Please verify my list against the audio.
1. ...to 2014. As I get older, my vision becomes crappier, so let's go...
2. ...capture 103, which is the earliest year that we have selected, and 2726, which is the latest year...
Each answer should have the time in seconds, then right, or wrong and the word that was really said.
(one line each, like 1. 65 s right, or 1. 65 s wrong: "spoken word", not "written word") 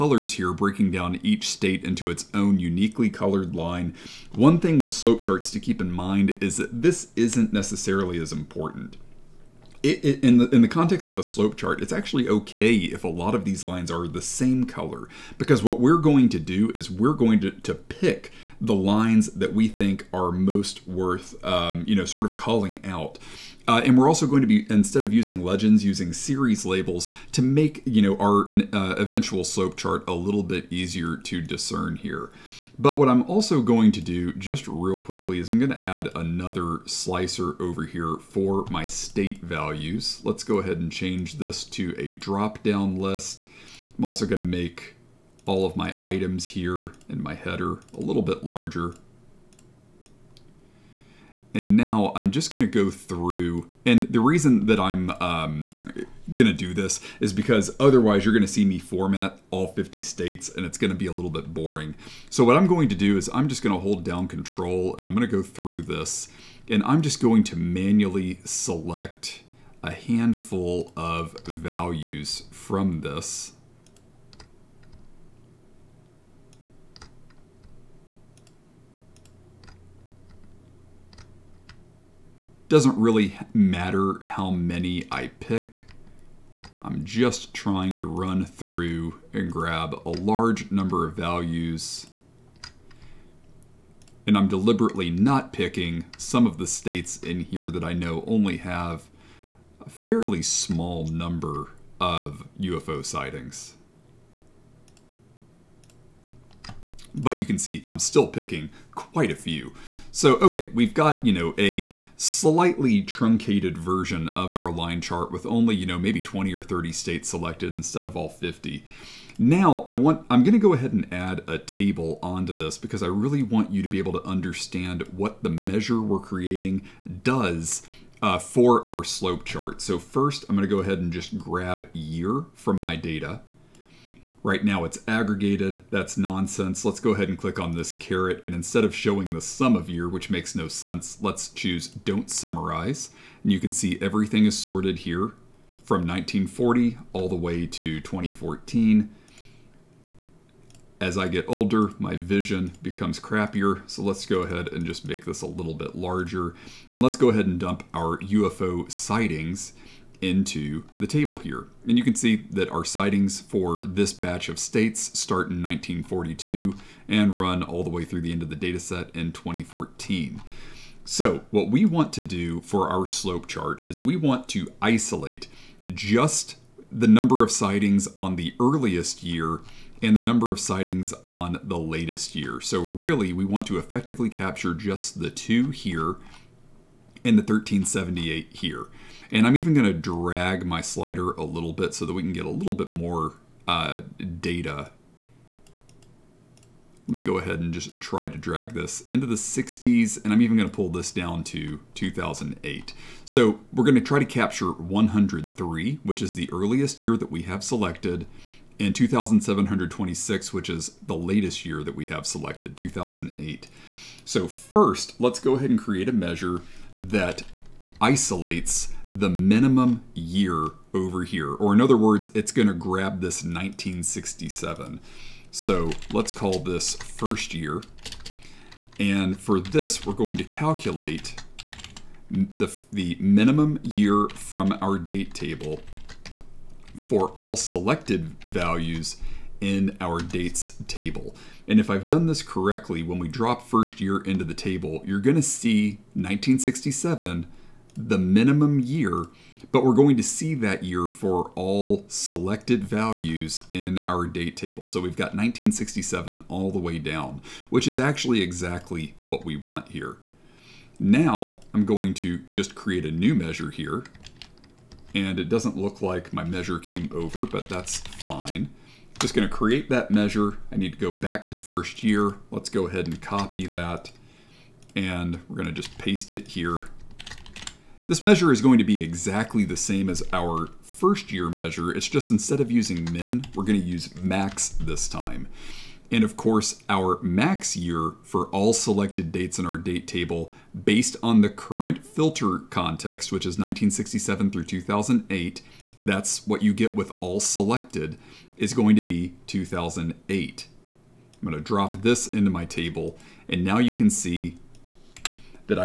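1. 147 s right
2. 204 s right.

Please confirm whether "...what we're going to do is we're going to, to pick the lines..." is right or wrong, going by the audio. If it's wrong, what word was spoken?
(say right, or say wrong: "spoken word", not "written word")
right.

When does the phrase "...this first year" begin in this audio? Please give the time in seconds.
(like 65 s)
226 s.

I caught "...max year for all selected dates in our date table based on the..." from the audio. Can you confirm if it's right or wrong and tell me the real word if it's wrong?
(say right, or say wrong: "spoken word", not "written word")
right.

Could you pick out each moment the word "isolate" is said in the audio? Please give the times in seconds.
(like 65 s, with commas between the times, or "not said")
174 s, 218 s.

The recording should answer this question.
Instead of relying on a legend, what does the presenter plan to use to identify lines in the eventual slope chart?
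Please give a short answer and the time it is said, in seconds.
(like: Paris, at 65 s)
Series labels, at 26 s.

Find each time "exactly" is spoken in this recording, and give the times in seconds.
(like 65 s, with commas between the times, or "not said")
258 s, 279 s.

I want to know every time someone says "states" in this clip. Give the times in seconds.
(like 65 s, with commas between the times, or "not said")
1 s, 38 s, 60 s, 96 s, 116 s, 164 s.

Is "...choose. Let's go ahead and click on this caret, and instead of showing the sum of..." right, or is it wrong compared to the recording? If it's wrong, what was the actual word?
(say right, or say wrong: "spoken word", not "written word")
wrong: "nonsense", not "choose".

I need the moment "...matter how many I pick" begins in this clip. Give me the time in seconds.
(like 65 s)
83 s.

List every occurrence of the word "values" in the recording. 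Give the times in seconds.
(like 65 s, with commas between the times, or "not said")
39 s, 71 s, 91 s, 238 s, 252 s.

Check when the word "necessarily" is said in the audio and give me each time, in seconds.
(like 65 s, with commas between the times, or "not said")
7 s.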